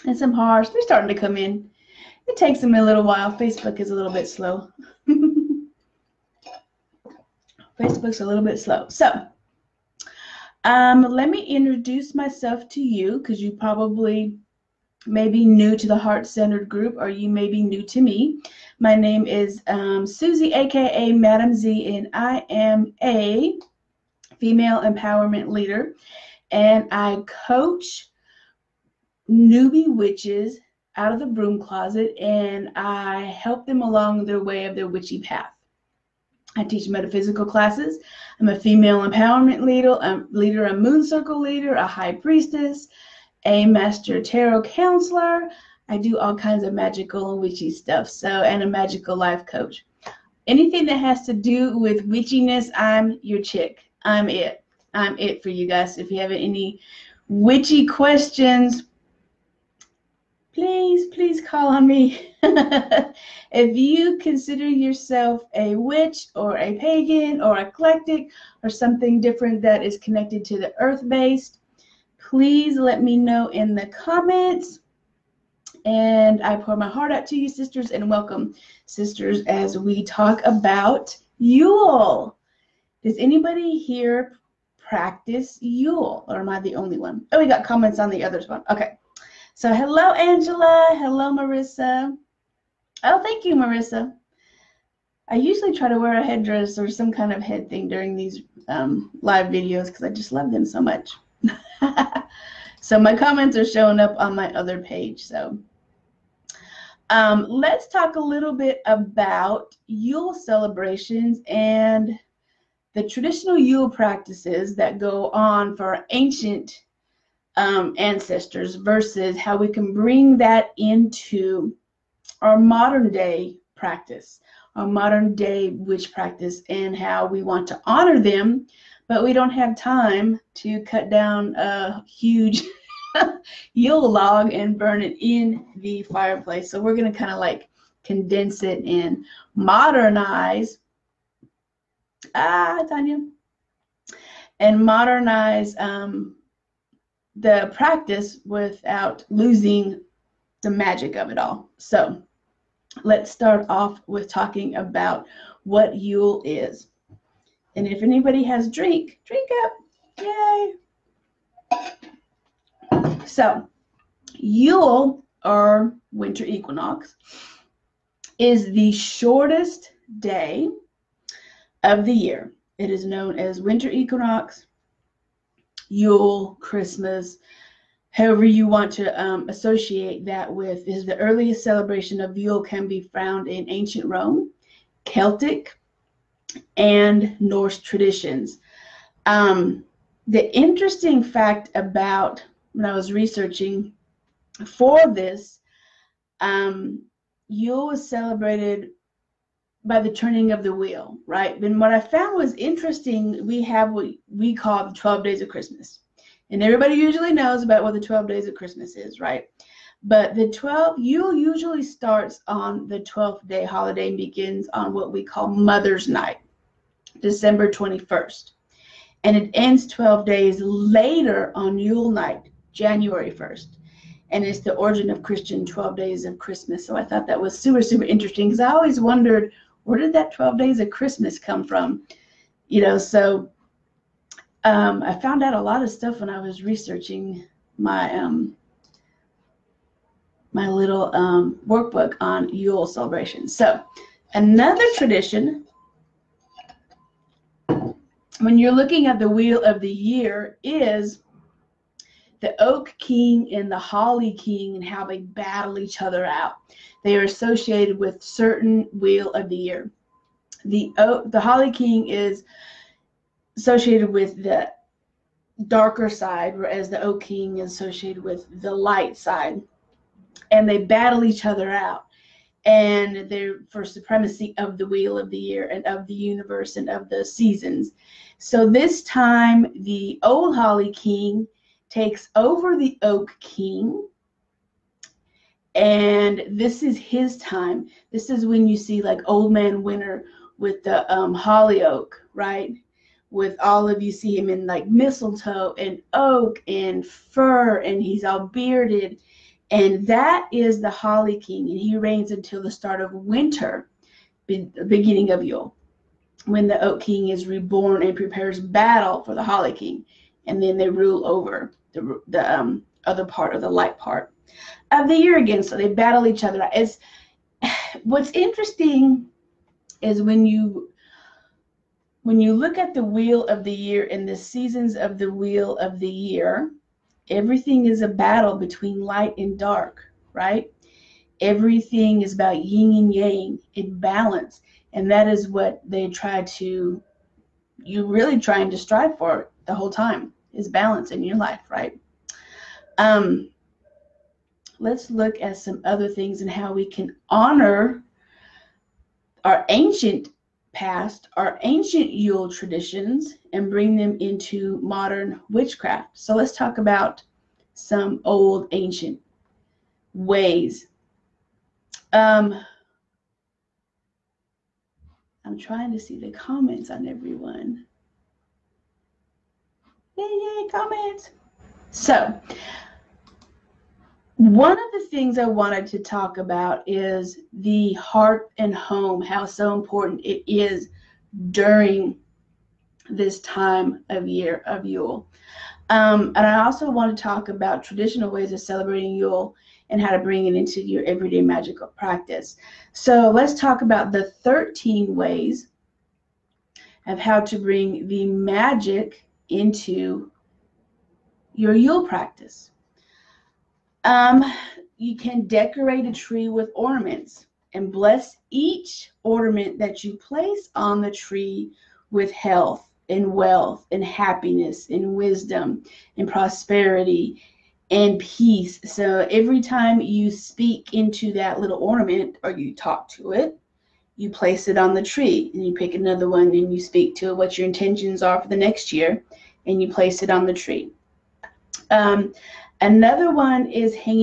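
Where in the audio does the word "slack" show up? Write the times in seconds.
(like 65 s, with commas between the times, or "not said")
not said.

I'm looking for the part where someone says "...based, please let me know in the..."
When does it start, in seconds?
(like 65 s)
71 s.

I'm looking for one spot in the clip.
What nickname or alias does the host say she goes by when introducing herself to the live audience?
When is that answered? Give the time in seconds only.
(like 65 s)
21 s.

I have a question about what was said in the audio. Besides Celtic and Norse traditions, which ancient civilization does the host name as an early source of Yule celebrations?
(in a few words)
Rome.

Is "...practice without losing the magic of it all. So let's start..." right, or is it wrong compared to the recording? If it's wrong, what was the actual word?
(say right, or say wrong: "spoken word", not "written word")
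right.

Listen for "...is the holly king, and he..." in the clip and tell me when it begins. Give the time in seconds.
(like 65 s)
300 s.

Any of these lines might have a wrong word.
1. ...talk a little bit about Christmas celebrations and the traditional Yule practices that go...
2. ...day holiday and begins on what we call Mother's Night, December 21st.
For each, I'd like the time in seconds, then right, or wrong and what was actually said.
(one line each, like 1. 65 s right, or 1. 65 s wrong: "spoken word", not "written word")
1. 107 s wrong: "Yule", not "Christmas"
2. 213 s right.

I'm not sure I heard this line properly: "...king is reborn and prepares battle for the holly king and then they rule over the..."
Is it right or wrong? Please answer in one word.
right.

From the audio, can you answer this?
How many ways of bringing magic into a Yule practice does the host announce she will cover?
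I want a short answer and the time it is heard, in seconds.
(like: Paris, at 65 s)
13, at 394 s.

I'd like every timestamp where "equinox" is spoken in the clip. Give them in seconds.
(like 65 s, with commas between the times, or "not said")
166 s, 173 s.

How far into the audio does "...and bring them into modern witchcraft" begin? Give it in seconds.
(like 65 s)
353 s.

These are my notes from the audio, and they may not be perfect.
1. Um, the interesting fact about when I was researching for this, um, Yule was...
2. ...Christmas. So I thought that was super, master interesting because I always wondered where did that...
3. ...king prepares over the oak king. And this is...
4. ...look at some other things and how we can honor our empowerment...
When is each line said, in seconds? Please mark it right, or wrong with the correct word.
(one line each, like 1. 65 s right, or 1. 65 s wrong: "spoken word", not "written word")
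1. 189 s right
2. 226 s wrong: "super", not "master"
3. 280 s wrong: "takes", not "prepares"
4. 345 s wrong: "ancient", not "empowerment".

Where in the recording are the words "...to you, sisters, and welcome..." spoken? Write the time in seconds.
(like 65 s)
77 s.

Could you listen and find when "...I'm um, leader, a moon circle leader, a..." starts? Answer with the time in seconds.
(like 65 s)
40 s.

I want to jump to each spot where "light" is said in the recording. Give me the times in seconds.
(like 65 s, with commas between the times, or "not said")
268 s, 313 s, 328 s.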